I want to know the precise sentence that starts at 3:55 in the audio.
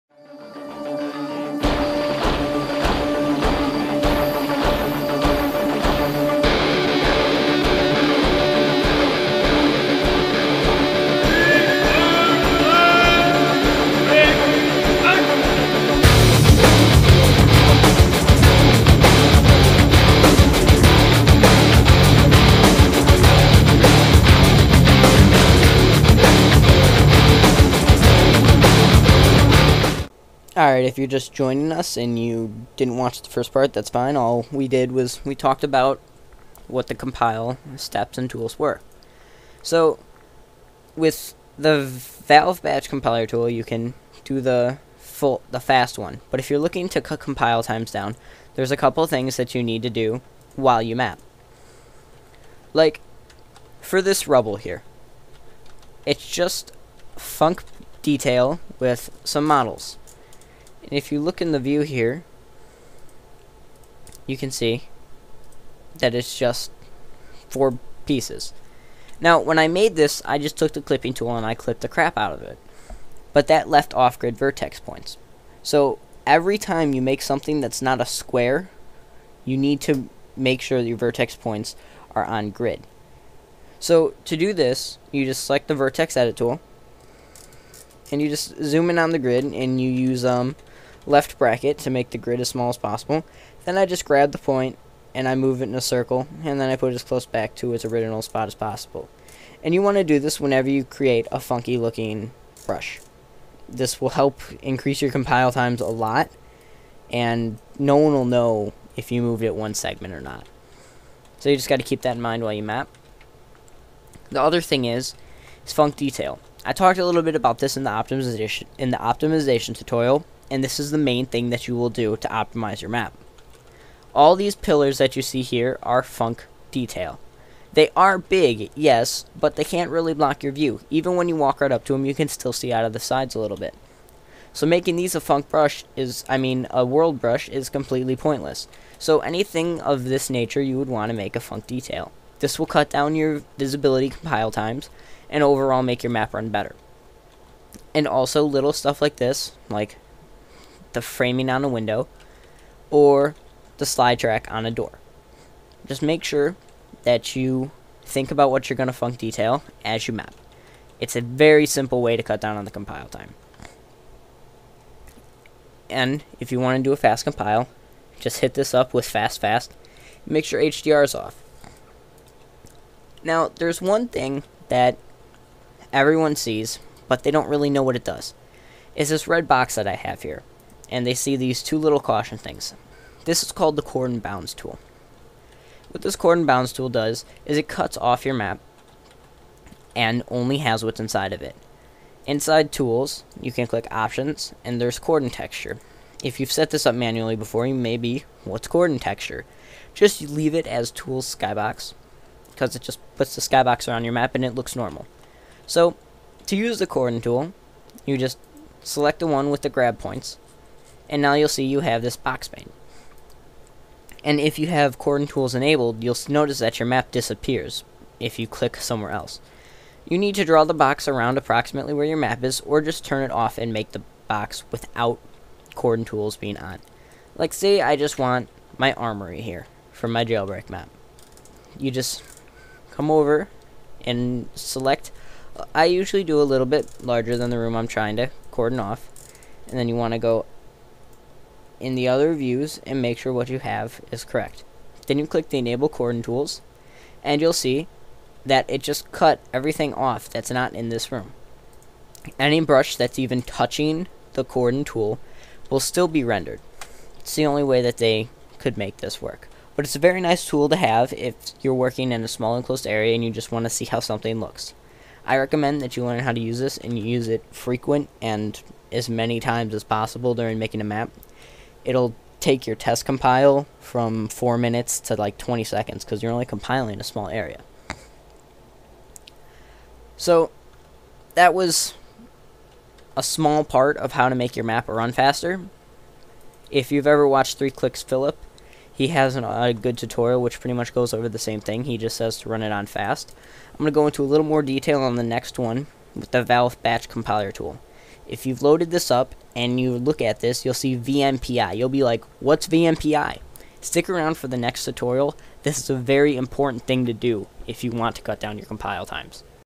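Uh, I usually do a little bit larger than the room I'm trying to cordon off.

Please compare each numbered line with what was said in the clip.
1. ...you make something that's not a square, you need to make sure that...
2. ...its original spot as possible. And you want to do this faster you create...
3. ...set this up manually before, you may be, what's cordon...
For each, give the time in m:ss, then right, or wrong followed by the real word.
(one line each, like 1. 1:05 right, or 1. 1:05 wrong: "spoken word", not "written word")
1. 1:16 right
2. 1:37 wrong: "whenever", not "faster"
3. 3:16 right.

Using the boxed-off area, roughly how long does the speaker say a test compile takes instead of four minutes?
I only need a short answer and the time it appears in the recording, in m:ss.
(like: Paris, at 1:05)
20 seconds, at 4:35.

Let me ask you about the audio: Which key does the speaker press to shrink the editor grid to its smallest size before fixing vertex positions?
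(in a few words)
Left bracket.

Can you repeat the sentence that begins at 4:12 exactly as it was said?
Any brush that's even touching the cordon tool will still be rendered.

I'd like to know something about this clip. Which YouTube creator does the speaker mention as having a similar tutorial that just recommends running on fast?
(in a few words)
3kliksphilip.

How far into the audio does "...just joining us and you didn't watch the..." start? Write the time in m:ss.
0:31.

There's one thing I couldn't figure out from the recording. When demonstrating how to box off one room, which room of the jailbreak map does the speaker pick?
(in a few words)
armory.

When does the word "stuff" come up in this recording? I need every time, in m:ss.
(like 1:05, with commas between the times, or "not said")
2:28.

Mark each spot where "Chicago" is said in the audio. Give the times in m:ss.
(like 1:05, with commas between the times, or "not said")
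not said.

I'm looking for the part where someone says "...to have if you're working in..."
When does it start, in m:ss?
4:20.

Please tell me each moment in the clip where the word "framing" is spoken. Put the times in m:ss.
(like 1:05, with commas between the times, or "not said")
2:31.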